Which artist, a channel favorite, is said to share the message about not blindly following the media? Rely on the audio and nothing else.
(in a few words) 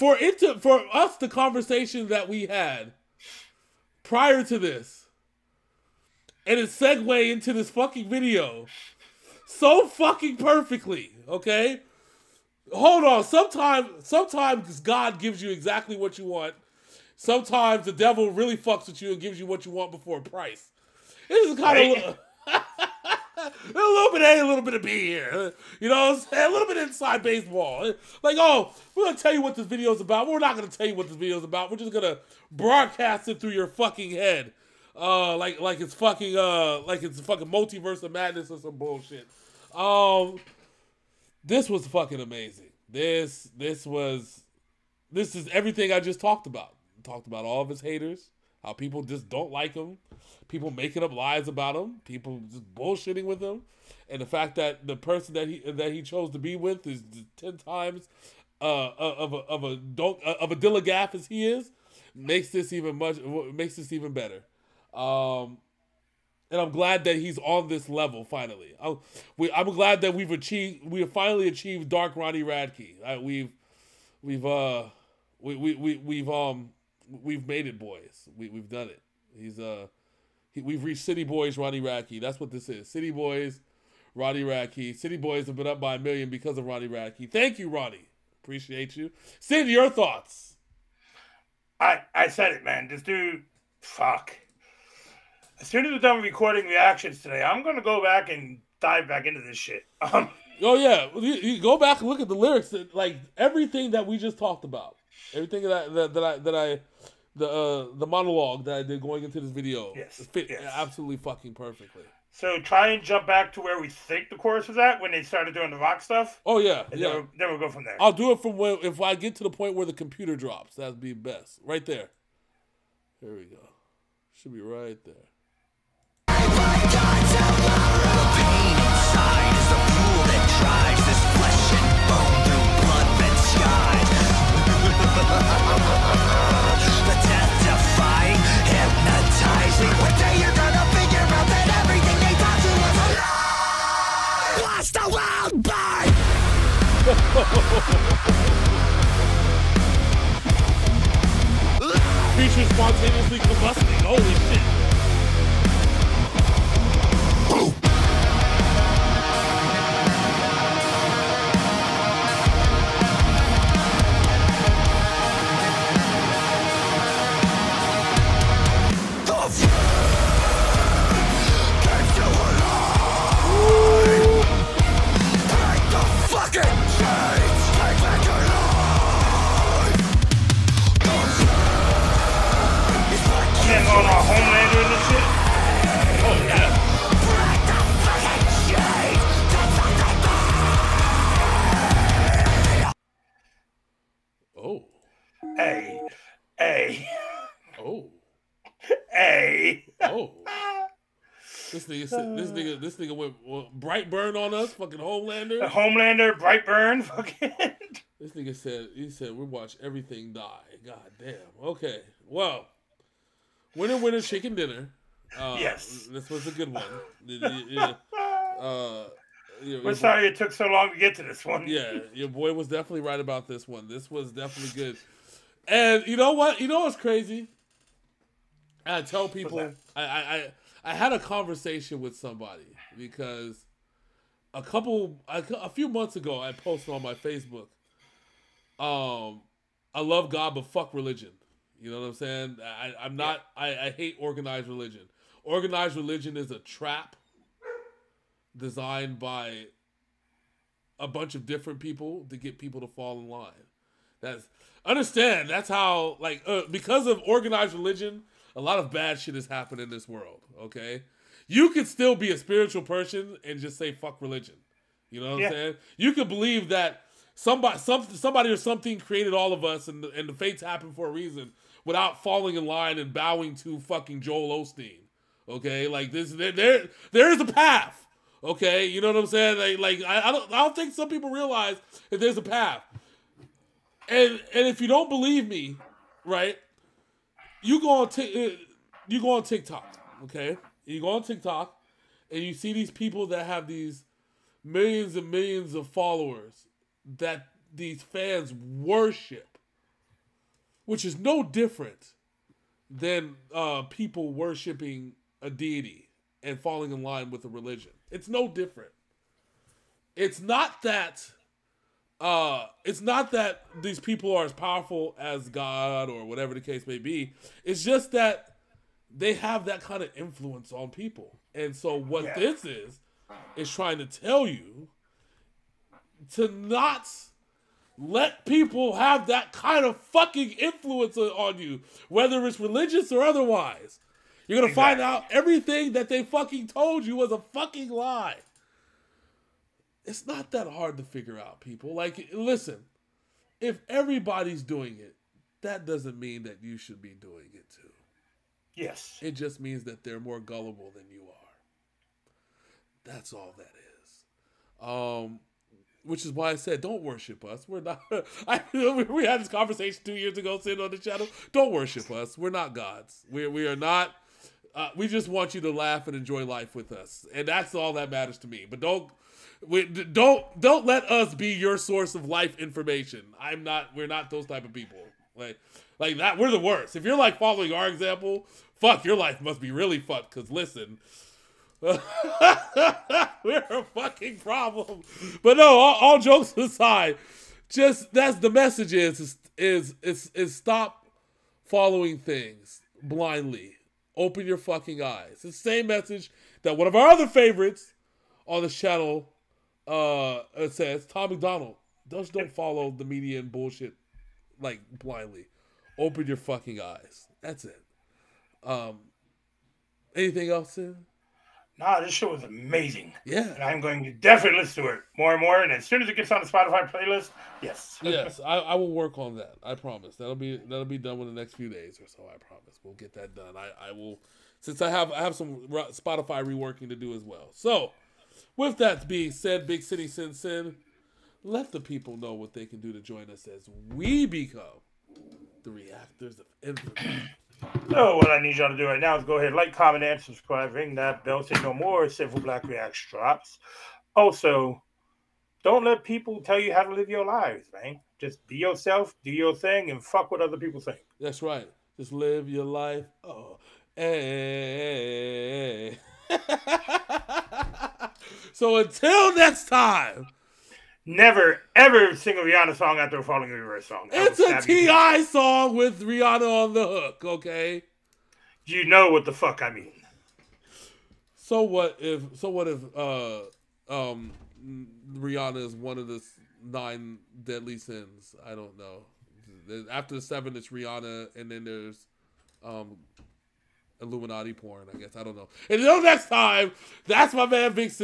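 Tom MacDonald.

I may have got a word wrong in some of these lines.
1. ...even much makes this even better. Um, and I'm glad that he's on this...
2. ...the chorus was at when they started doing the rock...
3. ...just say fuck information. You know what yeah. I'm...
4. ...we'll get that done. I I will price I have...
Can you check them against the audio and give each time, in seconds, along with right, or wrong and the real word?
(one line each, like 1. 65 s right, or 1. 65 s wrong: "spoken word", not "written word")
1. 62 s right
2. 114 s right
3. 263 s wrong: "religion", not "information"
4. 422 s wrong: "since", not "price".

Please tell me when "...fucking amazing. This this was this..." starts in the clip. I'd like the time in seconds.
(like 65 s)
41 s.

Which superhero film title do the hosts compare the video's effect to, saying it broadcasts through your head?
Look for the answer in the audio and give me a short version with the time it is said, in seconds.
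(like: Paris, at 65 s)
Multiverse of Madness, at 37 s.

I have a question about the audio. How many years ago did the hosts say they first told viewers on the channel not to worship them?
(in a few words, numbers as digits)
2.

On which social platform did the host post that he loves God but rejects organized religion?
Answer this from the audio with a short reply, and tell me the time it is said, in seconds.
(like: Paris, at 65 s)
Facebook, at 237 s.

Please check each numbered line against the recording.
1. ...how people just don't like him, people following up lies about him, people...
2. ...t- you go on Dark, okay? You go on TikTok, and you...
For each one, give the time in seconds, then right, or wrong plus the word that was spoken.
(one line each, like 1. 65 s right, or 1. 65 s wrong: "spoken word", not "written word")
1. 48 s wrong: "making", not "following"
2. 288 s wrong: "TikTok", not "Dark".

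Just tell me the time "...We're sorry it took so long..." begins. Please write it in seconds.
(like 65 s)
219 s.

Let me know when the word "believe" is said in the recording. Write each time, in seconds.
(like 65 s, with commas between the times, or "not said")
266 s, 285 s.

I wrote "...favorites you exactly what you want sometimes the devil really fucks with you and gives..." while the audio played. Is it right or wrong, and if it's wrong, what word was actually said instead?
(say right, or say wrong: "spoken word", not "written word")
wrong: "gives", not "favorites".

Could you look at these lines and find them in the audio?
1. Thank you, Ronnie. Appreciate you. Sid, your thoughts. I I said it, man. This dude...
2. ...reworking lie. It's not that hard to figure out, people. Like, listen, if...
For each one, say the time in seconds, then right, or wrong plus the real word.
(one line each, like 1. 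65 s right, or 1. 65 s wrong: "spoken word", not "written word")
1. 87 s right
2. 337 s wrong: "fucking", not "reworking".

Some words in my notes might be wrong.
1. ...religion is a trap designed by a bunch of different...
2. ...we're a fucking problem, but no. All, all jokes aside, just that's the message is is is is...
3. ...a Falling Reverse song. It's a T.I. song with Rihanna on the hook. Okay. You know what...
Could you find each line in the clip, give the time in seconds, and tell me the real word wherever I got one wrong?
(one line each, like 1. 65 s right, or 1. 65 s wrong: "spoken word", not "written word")
1. 245 s right
2. 381 s right
3. 463 s right.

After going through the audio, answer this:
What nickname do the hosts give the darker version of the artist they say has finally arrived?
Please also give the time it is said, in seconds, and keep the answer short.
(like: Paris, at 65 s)
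Dark Ronnie Radke, at 71 s.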